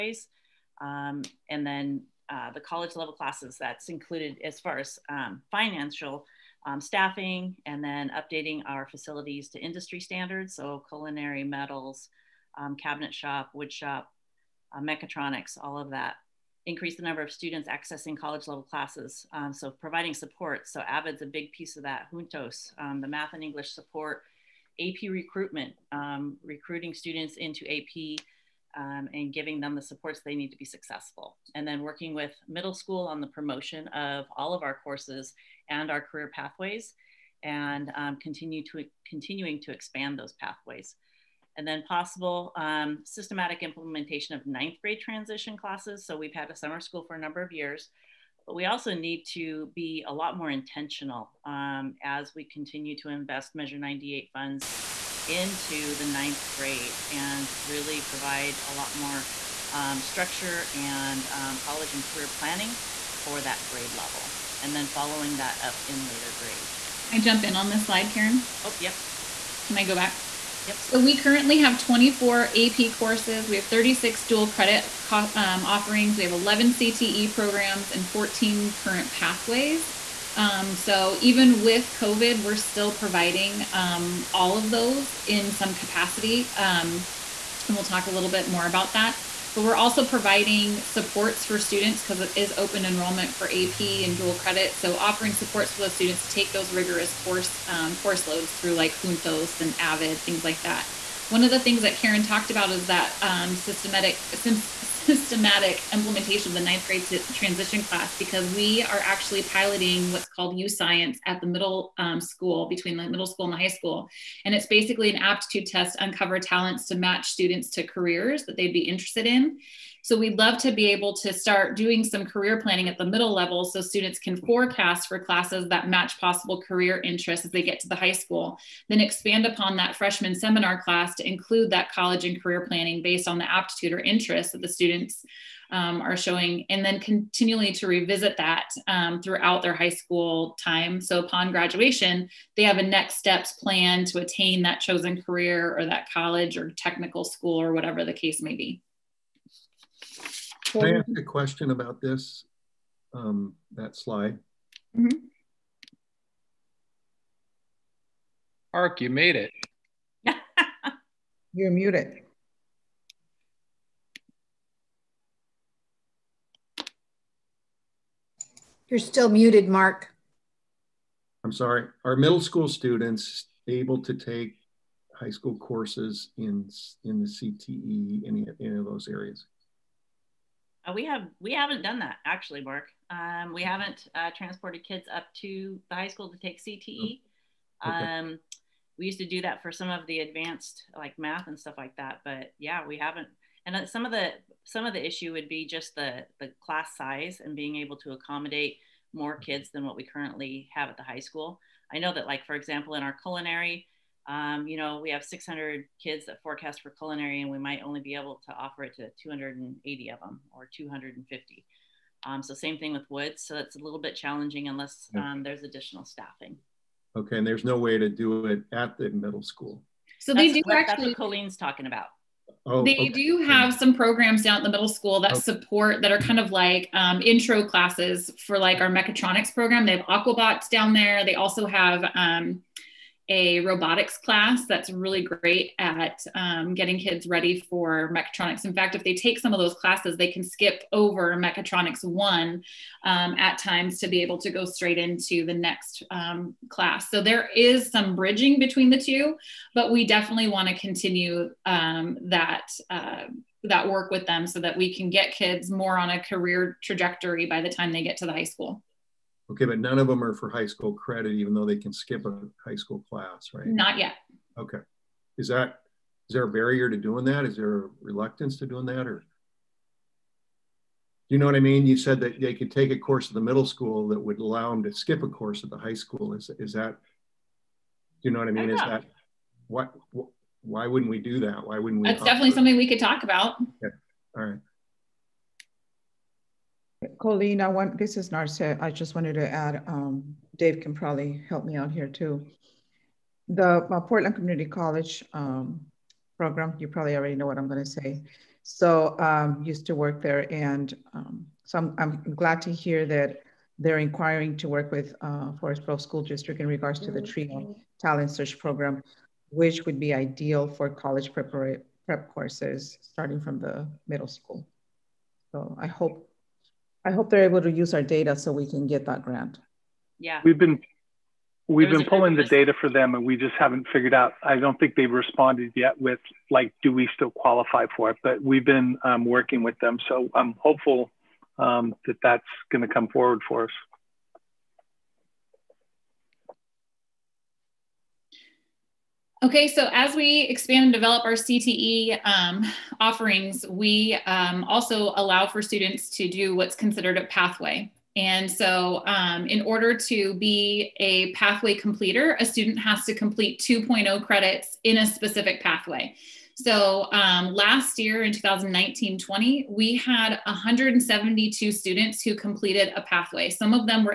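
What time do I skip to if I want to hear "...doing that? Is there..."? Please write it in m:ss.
4:26.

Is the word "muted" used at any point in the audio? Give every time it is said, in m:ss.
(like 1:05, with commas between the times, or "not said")
2:41, 2:49.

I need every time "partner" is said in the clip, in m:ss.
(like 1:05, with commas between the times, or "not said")
not said.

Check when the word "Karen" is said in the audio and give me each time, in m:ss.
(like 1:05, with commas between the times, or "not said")
1:08, 1:41.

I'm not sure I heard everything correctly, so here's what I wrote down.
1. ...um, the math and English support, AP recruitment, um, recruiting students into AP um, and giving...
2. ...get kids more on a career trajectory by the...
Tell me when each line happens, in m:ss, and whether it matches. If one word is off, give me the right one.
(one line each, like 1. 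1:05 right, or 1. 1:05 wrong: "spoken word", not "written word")
1. 0:22 right
2. 4:15 right.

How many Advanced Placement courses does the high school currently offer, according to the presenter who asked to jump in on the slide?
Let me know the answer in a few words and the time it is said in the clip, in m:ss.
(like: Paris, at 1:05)
24, at 1:11.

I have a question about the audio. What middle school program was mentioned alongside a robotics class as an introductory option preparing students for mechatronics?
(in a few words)
Aquabots.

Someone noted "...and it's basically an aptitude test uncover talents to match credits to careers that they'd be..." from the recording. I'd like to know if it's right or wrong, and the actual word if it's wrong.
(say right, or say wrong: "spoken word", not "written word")
wrong: "students", not "credits".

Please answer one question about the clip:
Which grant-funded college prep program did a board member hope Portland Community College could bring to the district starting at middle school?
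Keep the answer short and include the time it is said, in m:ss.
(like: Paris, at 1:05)
TRIO Talent Search, at 5:07.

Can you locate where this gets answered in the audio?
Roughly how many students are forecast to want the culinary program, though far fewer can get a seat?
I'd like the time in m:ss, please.
3:25.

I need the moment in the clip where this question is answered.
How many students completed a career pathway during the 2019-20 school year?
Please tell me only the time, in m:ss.
6:00.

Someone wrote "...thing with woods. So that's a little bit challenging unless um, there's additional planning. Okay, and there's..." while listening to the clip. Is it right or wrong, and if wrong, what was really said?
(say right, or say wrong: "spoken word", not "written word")
wrong: "staffing", not "planning".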